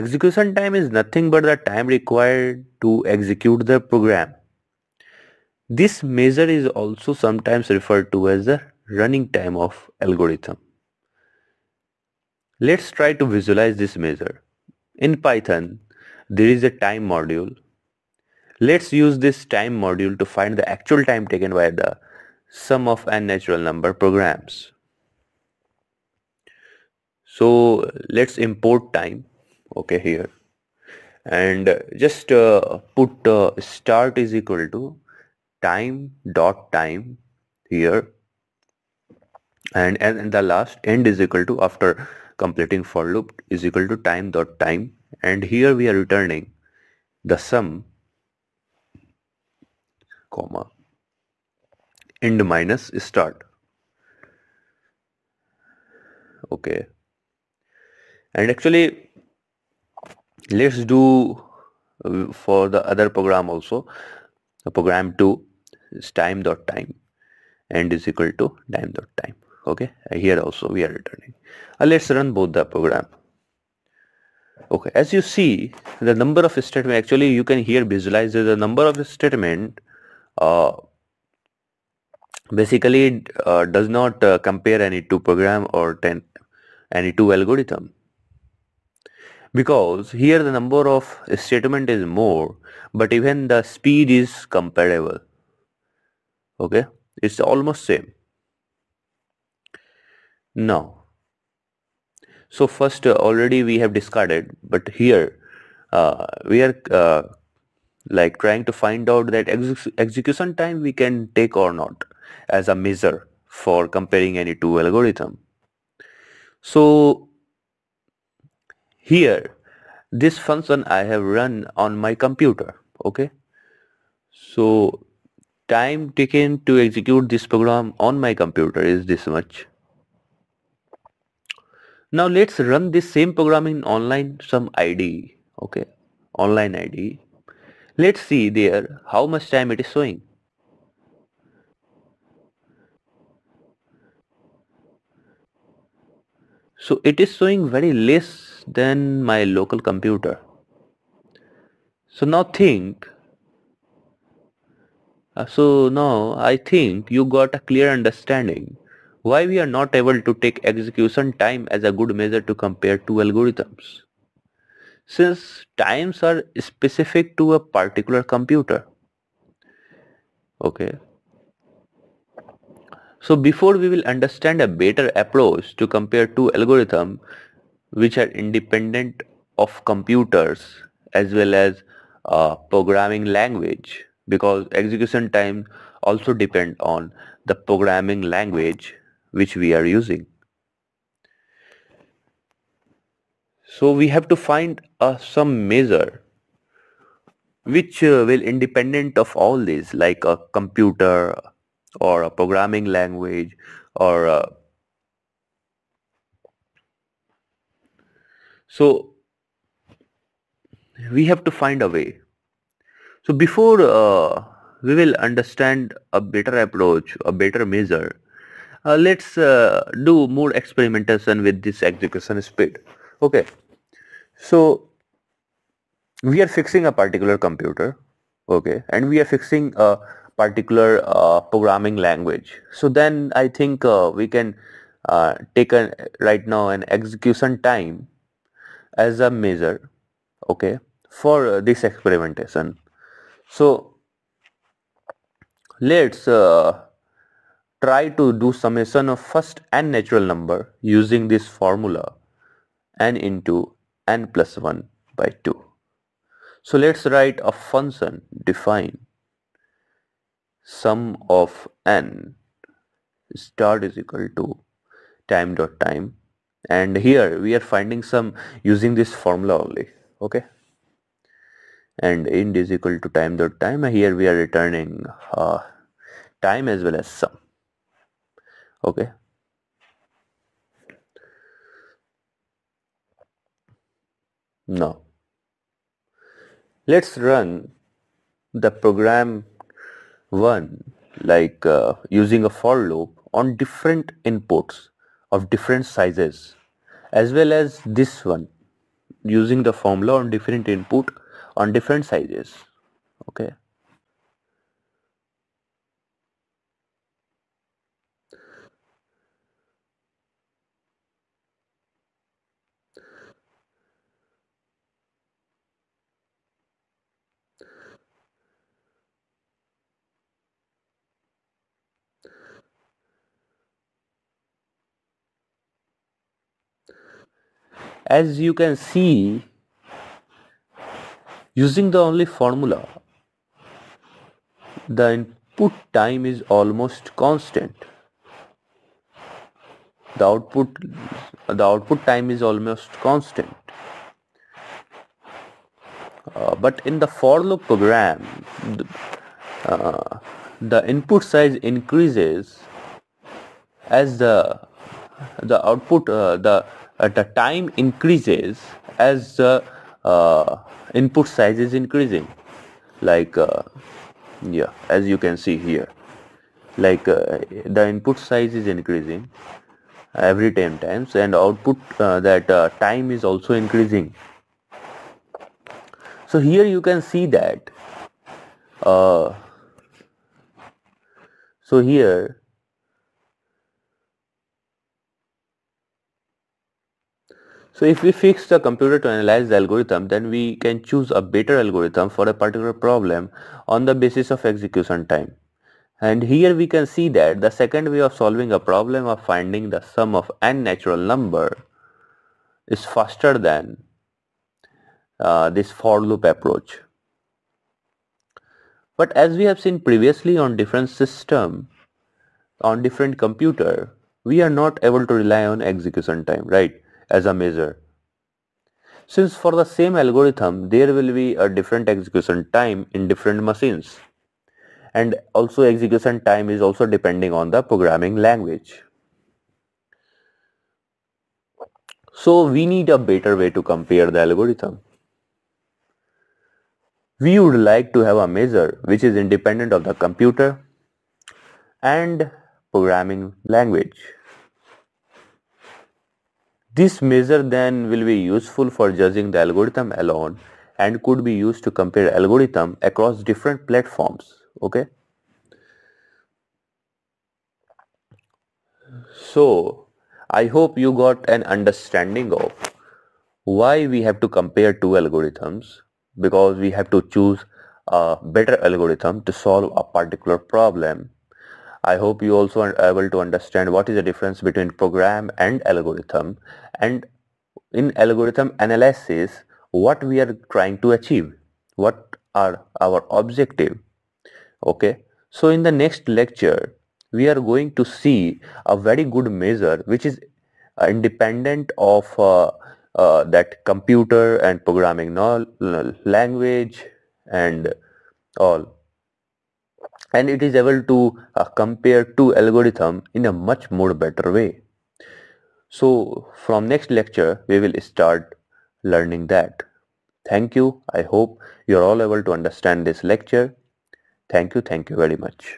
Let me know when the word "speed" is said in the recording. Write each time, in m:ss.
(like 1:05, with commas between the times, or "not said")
1:33, 3:42.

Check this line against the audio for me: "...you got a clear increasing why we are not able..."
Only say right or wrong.
wrong.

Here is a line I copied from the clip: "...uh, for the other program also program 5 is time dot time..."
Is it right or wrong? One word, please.
wrong.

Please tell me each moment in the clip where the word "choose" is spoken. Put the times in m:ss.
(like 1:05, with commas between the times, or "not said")
6:30, 7:47.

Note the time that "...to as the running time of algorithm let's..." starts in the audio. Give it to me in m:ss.
0:08.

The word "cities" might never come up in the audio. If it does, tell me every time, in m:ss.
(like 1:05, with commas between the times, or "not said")
not said.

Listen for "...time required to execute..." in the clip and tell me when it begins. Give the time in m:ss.
0:01.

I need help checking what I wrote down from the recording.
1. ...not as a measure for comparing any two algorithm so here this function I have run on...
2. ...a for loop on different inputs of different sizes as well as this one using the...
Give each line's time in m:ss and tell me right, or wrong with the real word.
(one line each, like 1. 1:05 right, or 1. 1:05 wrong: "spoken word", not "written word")
1. 1:51 right
2. 4:52 right.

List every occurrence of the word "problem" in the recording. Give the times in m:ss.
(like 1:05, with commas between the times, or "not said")
6:32, 6:38, 7:50.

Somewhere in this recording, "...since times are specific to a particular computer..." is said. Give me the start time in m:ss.
2:45.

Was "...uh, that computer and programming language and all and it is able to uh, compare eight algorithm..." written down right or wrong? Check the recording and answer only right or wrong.
wrong.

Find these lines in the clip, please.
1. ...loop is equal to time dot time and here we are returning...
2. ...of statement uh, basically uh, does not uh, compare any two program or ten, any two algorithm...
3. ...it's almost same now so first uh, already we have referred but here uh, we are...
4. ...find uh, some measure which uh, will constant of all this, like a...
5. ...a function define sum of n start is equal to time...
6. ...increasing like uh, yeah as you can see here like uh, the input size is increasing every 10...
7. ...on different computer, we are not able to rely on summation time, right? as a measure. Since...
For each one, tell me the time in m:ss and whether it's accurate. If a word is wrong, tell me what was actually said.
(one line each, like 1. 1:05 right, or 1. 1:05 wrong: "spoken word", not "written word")
1. 0:43 right
2. 1:18 right
3. 1:37 wrong: "discarded", not "referred"
4. 3:14 wrong: "independent", not "constant"
5. 4:17 right
6. 6:01 right
7. 6:52 wrong: "execution", not "summation".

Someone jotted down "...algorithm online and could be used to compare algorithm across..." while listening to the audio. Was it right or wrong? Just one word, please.
wrong.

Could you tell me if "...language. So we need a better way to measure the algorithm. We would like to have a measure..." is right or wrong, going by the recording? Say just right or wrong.
wrong.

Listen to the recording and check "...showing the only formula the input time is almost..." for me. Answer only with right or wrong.
wrong.